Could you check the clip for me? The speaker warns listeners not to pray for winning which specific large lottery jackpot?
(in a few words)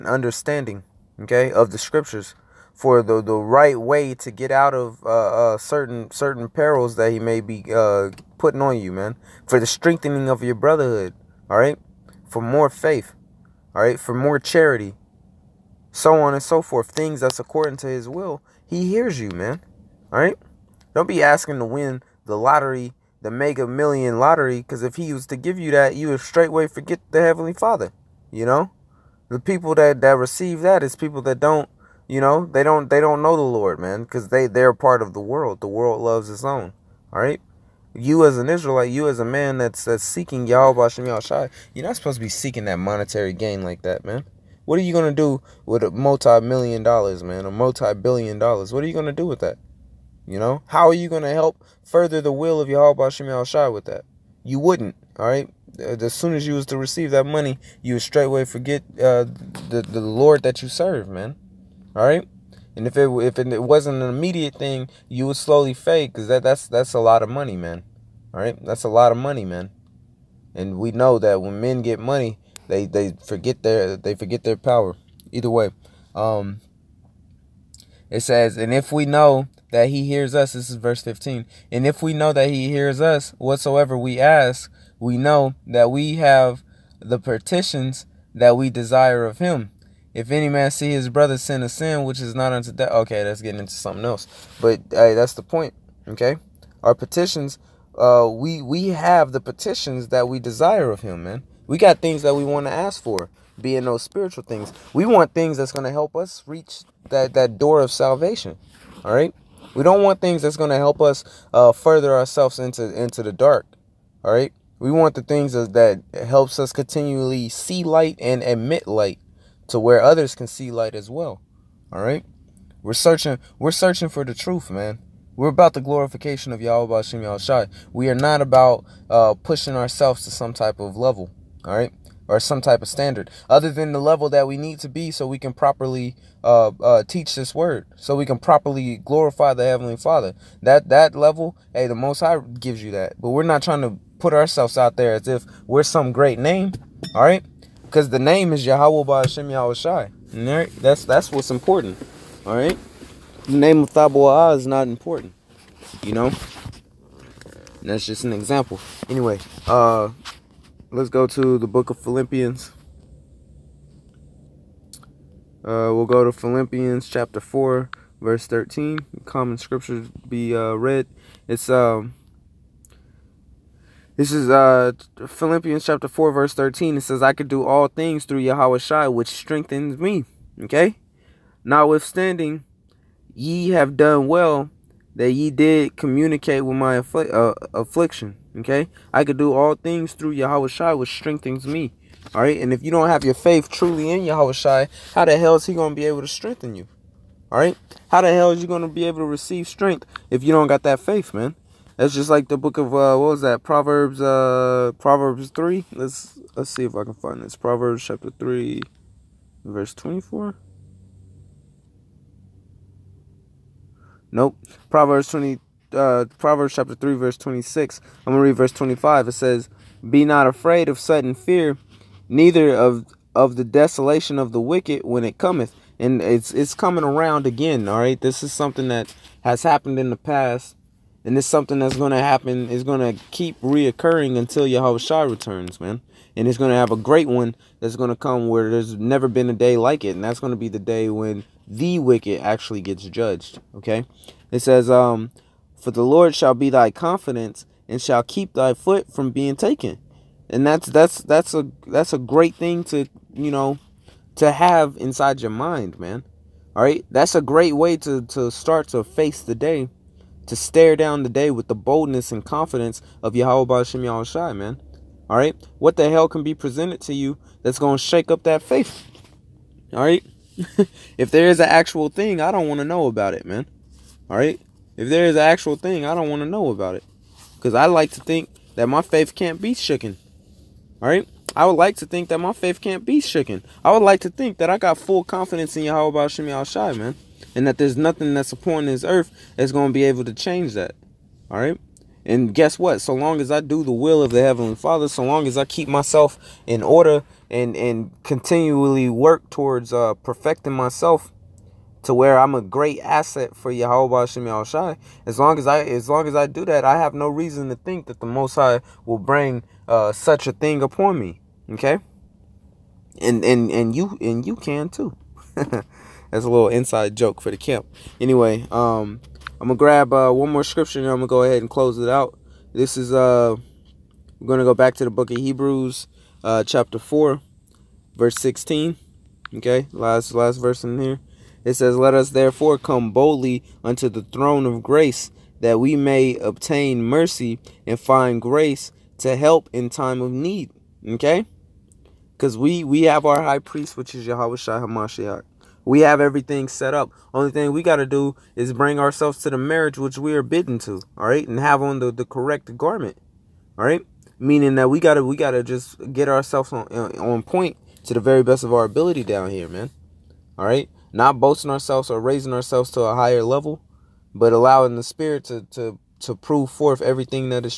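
Mega Million.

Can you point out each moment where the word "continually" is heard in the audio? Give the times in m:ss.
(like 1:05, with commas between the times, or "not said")
1:56, 4:58.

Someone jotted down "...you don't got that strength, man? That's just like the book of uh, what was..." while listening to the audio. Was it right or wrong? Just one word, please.
wrong.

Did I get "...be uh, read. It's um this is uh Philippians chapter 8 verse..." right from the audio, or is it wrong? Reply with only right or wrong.
wrong.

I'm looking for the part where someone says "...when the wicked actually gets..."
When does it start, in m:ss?
4:01.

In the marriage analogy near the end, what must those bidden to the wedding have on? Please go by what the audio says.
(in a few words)
the correct garment.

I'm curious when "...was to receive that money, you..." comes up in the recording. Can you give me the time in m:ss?
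0:56.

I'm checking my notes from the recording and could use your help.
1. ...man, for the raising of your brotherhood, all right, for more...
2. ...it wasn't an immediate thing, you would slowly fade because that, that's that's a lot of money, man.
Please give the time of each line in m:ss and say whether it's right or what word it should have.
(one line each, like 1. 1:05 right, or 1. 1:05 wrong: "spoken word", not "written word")
1. 0:08 wrong: "strengthening", not "raising"
2. 1:03 right.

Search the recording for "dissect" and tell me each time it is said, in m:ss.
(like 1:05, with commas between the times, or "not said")
not said.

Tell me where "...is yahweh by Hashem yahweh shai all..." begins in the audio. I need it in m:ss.
2:28.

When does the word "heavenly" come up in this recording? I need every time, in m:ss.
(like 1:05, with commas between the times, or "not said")
0:27, 2:19, 4:54.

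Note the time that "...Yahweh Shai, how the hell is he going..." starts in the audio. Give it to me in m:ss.
3:14.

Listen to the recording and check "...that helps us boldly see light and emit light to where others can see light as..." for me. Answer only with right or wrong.
wrong.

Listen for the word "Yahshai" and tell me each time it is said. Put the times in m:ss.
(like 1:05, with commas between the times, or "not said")
0:40, 2:07.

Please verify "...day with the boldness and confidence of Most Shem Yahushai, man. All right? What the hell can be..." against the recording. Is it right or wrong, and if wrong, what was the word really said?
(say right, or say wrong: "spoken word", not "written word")
wrong: "Yahweh", not "Most".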